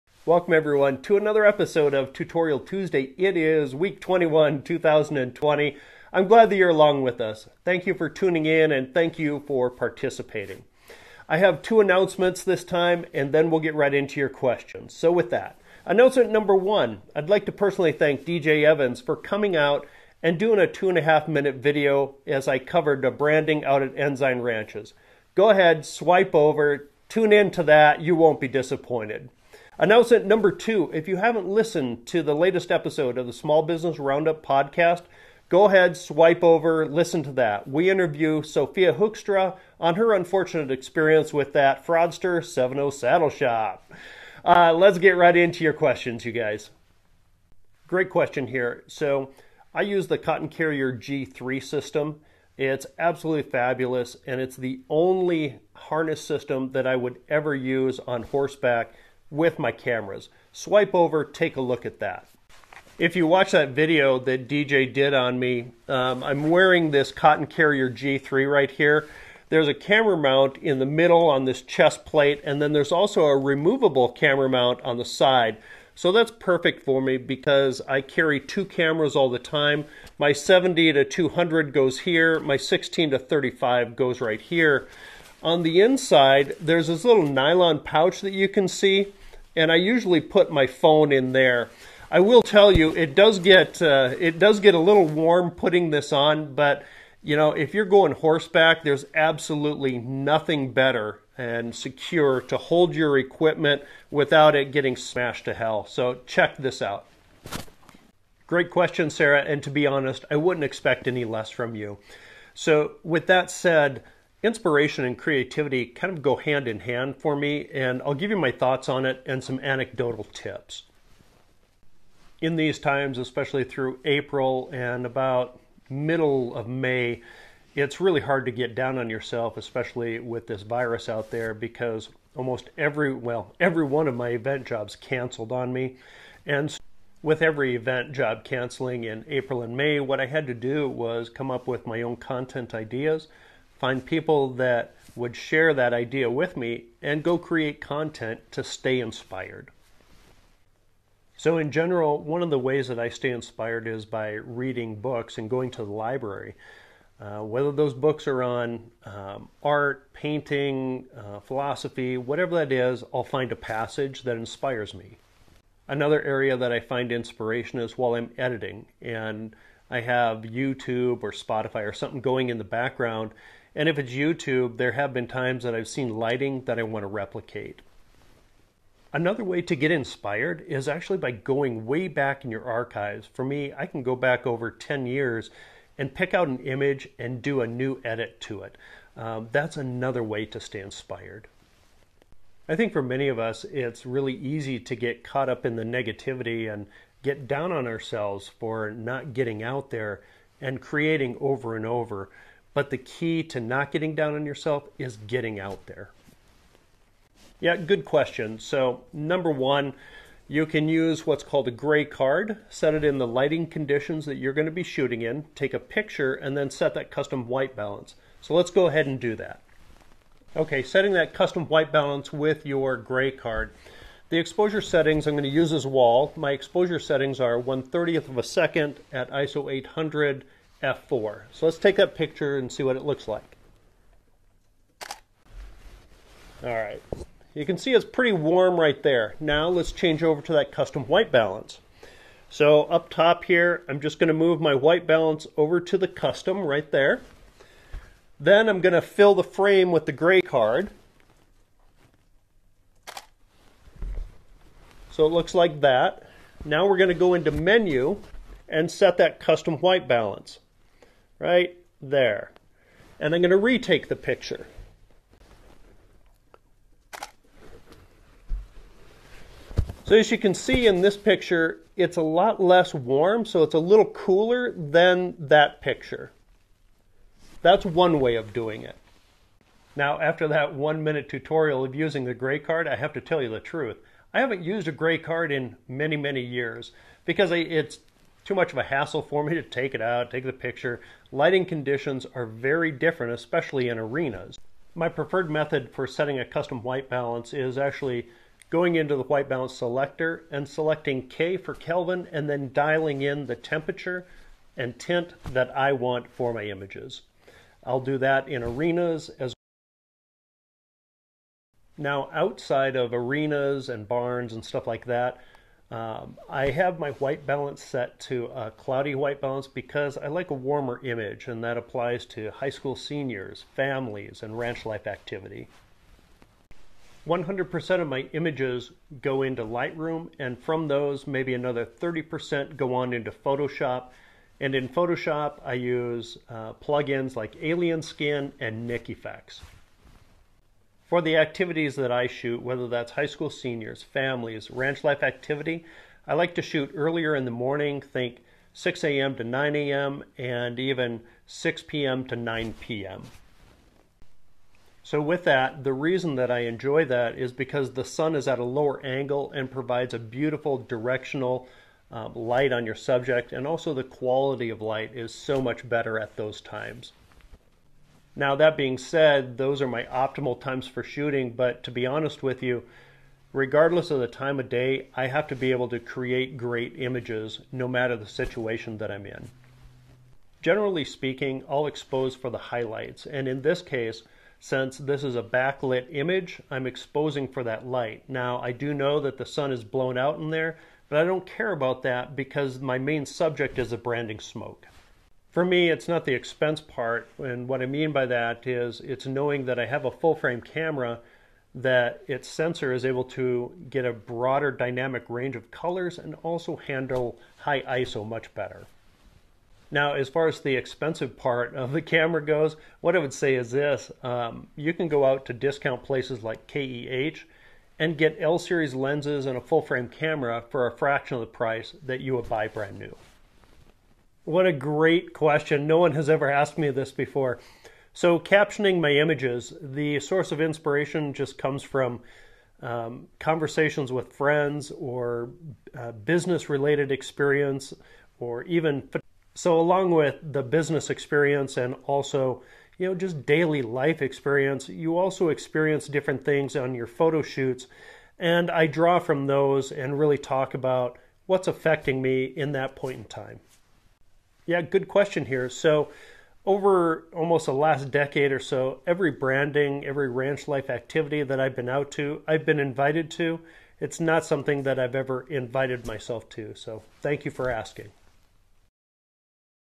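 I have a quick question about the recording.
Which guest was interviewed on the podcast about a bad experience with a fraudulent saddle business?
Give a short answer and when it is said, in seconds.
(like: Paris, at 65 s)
Sophia Hoekstra, at 38 s.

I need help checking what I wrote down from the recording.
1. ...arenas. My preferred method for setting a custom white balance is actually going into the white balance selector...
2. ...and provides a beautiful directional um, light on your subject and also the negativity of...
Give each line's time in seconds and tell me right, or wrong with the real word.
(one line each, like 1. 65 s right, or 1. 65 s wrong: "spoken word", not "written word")
1. 293 s right
2. 359 s wrong: "quality", not "negativity".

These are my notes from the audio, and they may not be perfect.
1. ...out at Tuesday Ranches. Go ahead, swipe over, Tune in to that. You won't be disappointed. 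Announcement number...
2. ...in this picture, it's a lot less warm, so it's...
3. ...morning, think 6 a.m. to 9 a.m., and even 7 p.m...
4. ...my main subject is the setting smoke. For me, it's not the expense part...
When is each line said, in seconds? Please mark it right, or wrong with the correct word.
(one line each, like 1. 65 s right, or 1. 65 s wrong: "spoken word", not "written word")
1. 23 s wrong: "Enzyme", not "Tuesday"
2. 270 s right
3. 347 s wrong: "6", not "7"
4. 392 s wrong: "branding", not "setting".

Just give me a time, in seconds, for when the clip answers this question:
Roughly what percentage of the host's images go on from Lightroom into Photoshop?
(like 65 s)
331 s.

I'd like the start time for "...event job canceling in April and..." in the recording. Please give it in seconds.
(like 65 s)
137 s.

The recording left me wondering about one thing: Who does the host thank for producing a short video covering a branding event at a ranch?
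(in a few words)
DJ Evans.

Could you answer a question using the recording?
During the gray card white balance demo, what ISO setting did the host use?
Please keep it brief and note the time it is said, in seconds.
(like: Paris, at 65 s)
800, at 229 s.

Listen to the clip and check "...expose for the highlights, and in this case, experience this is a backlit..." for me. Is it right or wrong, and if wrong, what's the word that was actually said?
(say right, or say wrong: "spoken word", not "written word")
wrong: "since", not "experience".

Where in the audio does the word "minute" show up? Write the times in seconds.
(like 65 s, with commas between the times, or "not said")
21 s, 281 s.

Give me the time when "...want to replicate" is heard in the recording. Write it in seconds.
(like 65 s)
176 s.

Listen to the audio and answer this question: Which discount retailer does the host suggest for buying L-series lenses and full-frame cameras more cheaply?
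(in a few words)
KEH.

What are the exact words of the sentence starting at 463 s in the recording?
It's not something that I've ever invited myself to.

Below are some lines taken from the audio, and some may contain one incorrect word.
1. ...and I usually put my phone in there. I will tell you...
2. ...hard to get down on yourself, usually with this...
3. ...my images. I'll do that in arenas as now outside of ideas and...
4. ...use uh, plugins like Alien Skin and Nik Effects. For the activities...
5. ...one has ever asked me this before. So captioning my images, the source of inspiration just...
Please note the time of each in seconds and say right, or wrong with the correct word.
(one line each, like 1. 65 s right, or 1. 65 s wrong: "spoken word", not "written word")
1. 89 s right
2. 128 s wrong: "especially", not "usually"
3. 306 s wrong: "arenas", not "ideas"
4. 335 s right
5. 425 s right.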